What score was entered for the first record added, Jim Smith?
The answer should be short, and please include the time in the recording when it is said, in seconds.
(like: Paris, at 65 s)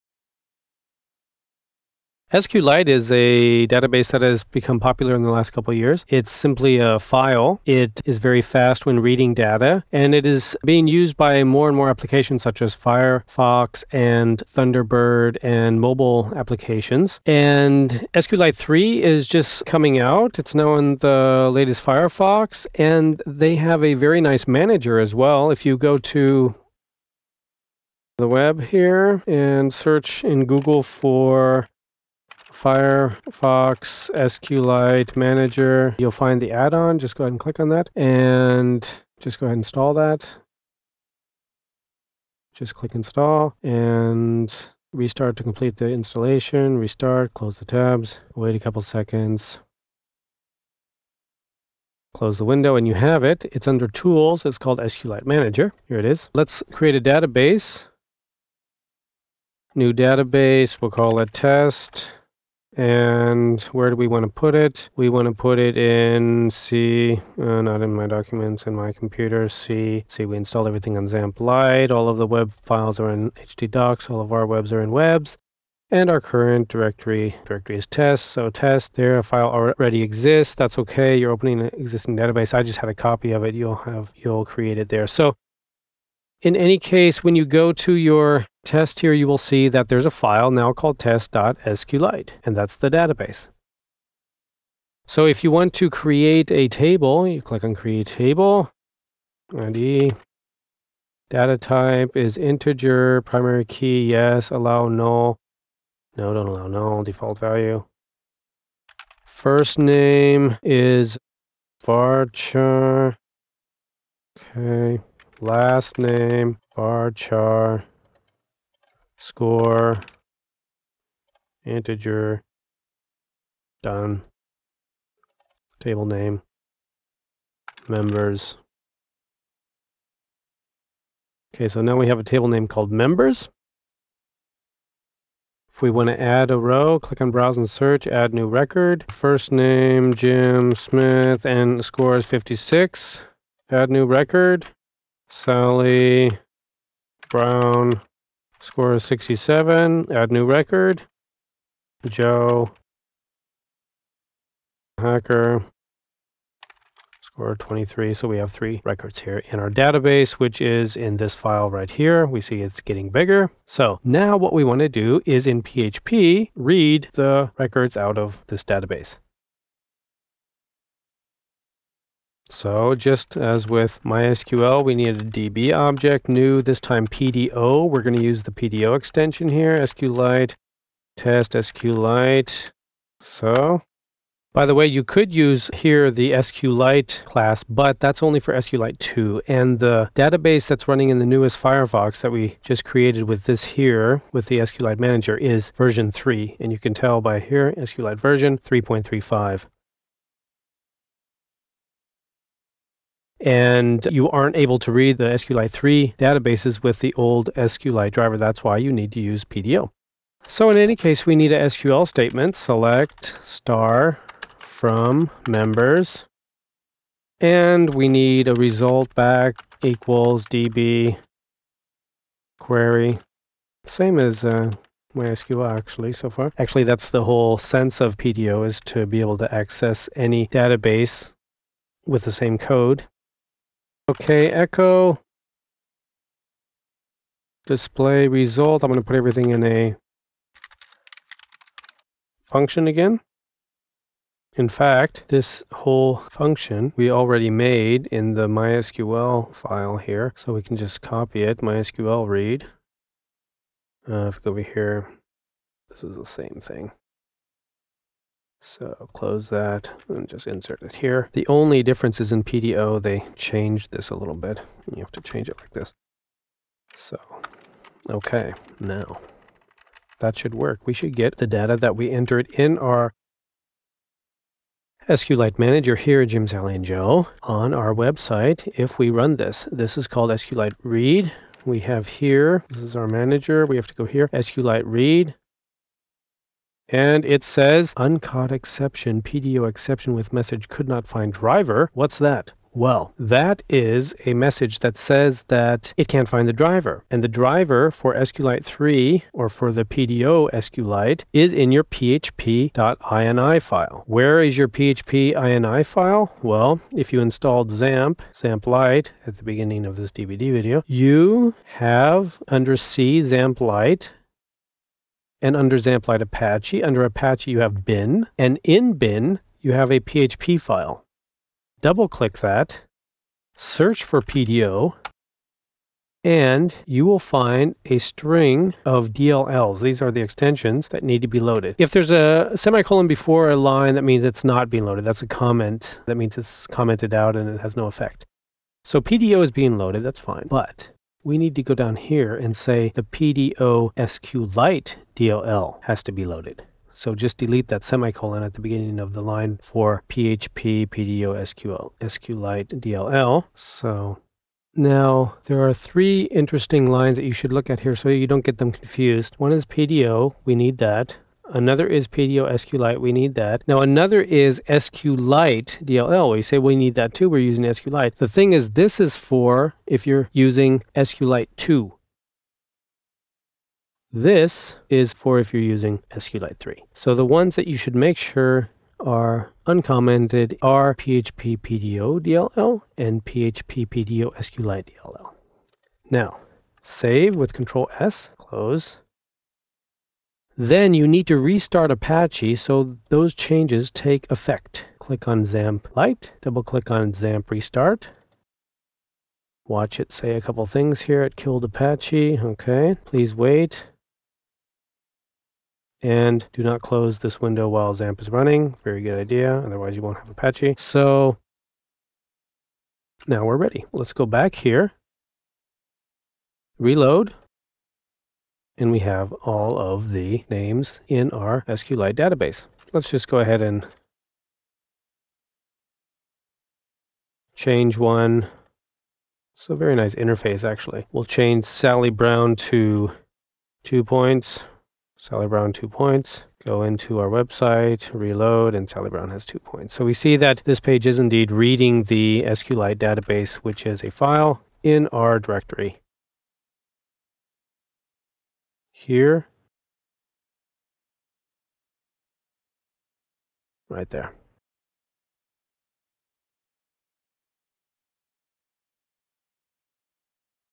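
56, at 142 s.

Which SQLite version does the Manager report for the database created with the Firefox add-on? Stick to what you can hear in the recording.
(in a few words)
3.35.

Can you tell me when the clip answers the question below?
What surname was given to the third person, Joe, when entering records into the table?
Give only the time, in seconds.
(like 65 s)
154 s.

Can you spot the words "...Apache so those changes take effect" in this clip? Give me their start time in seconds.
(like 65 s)
391 s.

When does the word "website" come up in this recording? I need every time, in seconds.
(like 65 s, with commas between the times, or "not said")
277 s, 437 s.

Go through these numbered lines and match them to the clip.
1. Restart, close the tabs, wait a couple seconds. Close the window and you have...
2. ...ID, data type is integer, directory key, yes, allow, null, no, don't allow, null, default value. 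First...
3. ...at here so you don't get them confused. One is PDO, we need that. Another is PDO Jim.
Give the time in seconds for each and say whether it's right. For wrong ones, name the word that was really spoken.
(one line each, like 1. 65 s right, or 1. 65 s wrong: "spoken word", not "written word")
1. 46 s right
2. 99 s wrong: "primary", not "directory"
3. 357 s wrong: "SQLite", not "Jim".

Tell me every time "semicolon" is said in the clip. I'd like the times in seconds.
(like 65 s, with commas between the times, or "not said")
332 s, 347 s.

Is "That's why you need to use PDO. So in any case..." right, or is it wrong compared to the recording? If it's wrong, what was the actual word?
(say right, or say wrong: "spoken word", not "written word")
right.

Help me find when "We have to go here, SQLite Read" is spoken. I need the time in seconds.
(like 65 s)
283 s.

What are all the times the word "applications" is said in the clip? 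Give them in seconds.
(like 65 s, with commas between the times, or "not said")
11 s, 16 s.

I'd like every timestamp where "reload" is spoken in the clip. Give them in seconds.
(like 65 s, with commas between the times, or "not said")
416 s, 438 s.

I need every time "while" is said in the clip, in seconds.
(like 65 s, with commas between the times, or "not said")
407 s.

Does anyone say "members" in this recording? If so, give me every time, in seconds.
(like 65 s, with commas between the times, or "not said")
127 s, 132 s, 215 s.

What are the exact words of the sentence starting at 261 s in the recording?
The only difference is in PDO, they changed this a little bit.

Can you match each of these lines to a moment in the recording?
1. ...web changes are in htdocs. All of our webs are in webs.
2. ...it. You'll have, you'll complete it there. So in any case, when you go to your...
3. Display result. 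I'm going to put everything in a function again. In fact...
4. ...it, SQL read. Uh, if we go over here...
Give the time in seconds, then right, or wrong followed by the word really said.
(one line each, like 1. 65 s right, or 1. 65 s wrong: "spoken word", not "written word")
1. 72 s wrong: "files", not "changes"
2. 83 s wrong: "create", not "complete"
3. 237 s right
4. 251 s wrong: "MySQL", not "SQL".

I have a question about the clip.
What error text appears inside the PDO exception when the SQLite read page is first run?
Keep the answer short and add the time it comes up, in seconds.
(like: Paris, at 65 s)
could not find driver, at 290 s.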